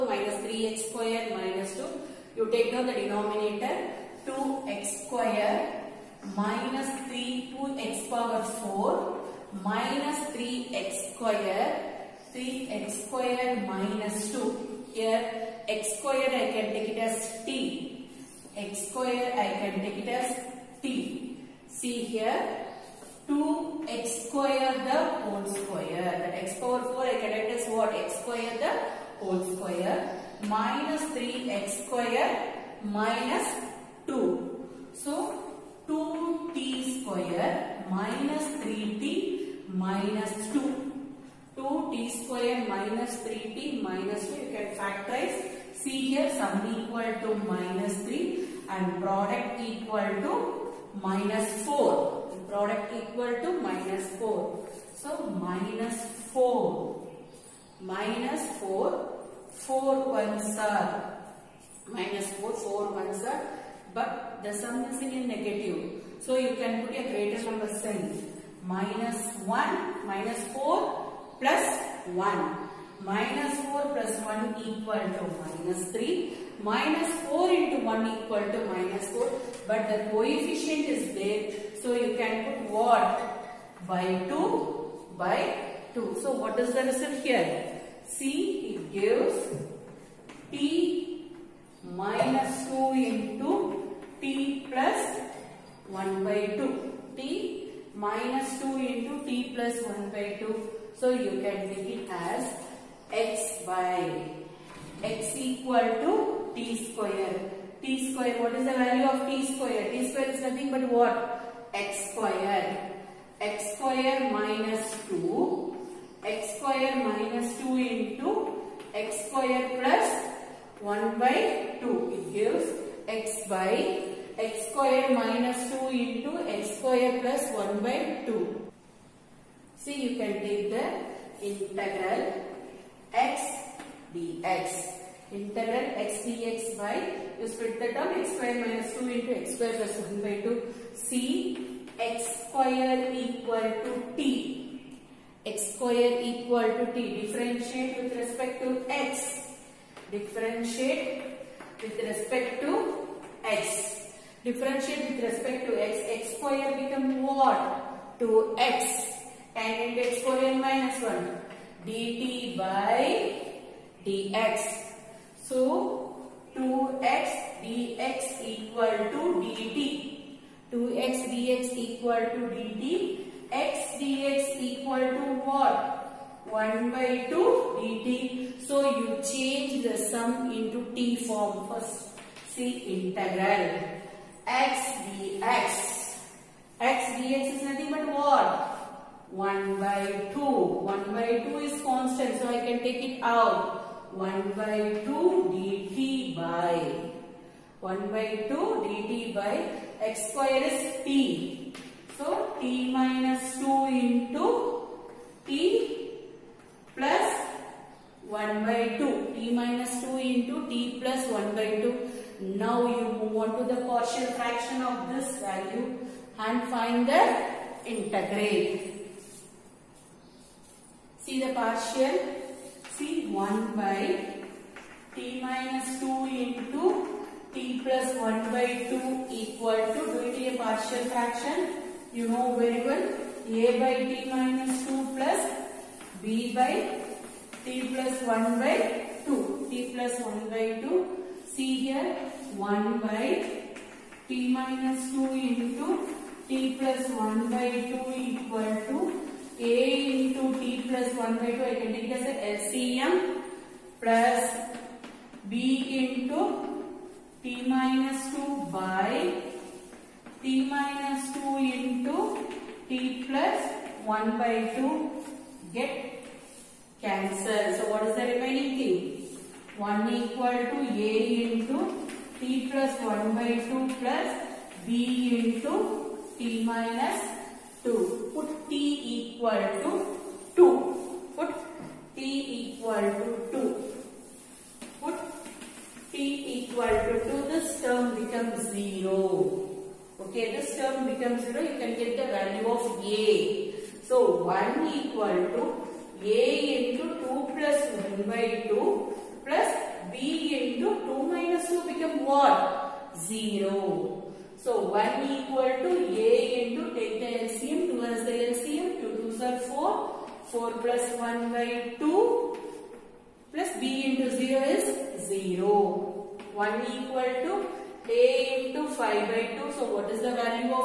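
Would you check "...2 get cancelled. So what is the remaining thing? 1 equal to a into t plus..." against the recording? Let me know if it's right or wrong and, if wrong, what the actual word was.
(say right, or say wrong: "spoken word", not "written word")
right.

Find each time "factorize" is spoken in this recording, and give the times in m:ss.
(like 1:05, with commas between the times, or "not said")
0:44.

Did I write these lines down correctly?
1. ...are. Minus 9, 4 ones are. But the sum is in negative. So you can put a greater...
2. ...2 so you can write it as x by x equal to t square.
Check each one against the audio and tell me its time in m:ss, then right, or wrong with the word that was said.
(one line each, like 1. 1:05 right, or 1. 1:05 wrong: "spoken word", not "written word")
1. 1:00 wrong: "4", not "9"
2. 1:40 right.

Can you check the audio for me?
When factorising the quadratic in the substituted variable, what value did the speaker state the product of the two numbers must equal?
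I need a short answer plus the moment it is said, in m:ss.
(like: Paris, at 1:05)
-4, at 0:52.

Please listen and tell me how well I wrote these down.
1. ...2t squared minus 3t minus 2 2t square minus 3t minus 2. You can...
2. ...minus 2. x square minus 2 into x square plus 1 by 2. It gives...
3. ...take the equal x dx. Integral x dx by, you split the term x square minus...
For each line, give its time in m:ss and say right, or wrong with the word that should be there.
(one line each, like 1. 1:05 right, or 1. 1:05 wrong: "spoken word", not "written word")
1. 0:35 right
2. 1:54 right
3. 2:10 wrong: "integral", not "equal".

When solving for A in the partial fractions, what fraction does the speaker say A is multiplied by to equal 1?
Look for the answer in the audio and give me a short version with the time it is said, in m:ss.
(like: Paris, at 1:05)
5/2, at 5:18.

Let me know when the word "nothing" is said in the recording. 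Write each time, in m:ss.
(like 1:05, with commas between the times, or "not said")
1:50, 3:07.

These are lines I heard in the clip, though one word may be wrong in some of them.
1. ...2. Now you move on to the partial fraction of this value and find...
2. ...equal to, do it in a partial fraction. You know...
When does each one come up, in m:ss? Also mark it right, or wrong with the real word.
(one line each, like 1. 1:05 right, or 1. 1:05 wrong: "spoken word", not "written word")
1. 3:31 right
2. 3:49 right.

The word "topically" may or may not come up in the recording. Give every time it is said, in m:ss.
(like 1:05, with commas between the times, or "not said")
not said.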